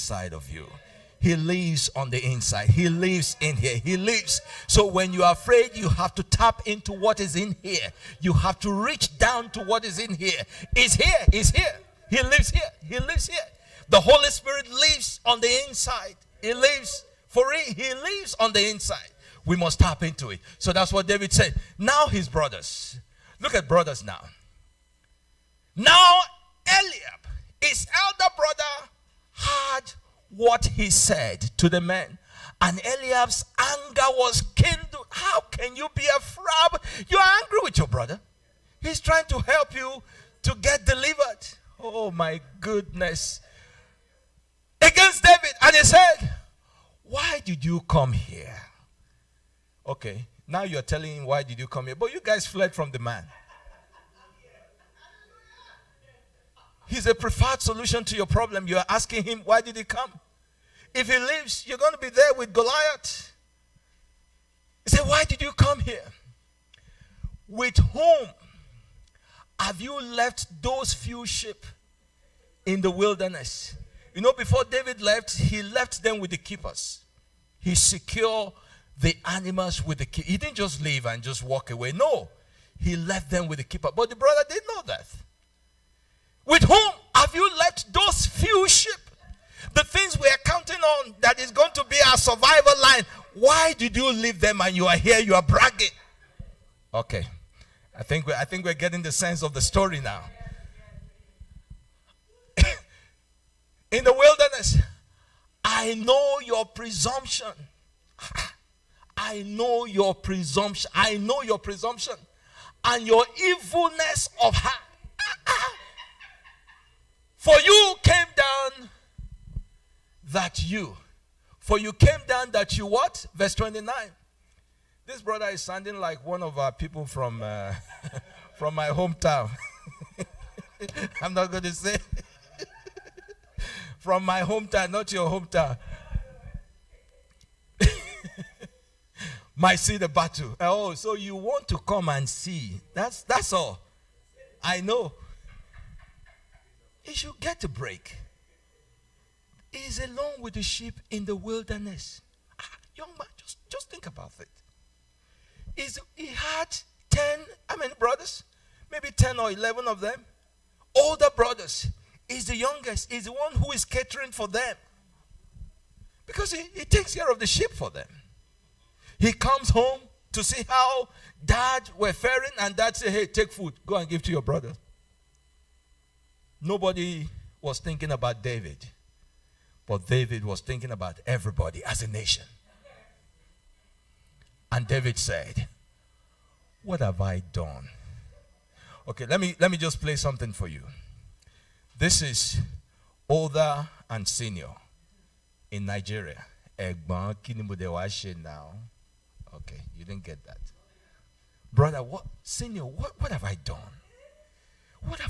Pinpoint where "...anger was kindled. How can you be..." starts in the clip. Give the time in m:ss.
0:33.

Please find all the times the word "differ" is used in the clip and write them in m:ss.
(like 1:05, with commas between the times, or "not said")
not said.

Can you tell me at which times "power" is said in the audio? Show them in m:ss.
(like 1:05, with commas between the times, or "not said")
not said.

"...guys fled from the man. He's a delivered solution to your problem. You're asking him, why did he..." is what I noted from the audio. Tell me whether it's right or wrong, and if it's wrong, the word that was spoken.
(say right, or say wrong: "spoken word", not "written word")
wrong: "preferred", not "delivered".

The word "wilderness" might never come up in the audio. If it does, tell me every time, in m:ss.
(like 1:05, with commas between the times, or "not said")
1:12, 1:44, 2:31.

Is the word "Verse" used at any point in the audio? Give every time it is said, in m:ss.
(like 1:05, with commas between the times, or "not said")
2:03.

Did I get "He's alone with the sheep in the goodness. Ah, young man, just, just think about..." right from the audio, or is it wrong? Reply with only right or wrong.
wrong.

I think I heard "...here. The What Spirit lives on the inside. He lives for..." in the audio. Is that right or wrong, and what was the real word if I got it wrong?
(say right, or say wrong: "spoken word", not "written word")
wrong: "Holy", not "What".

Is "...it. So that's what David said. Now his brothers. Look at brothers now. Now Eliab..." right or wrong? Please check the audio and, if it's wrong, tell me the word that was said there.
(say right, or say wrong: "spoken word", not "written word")
right.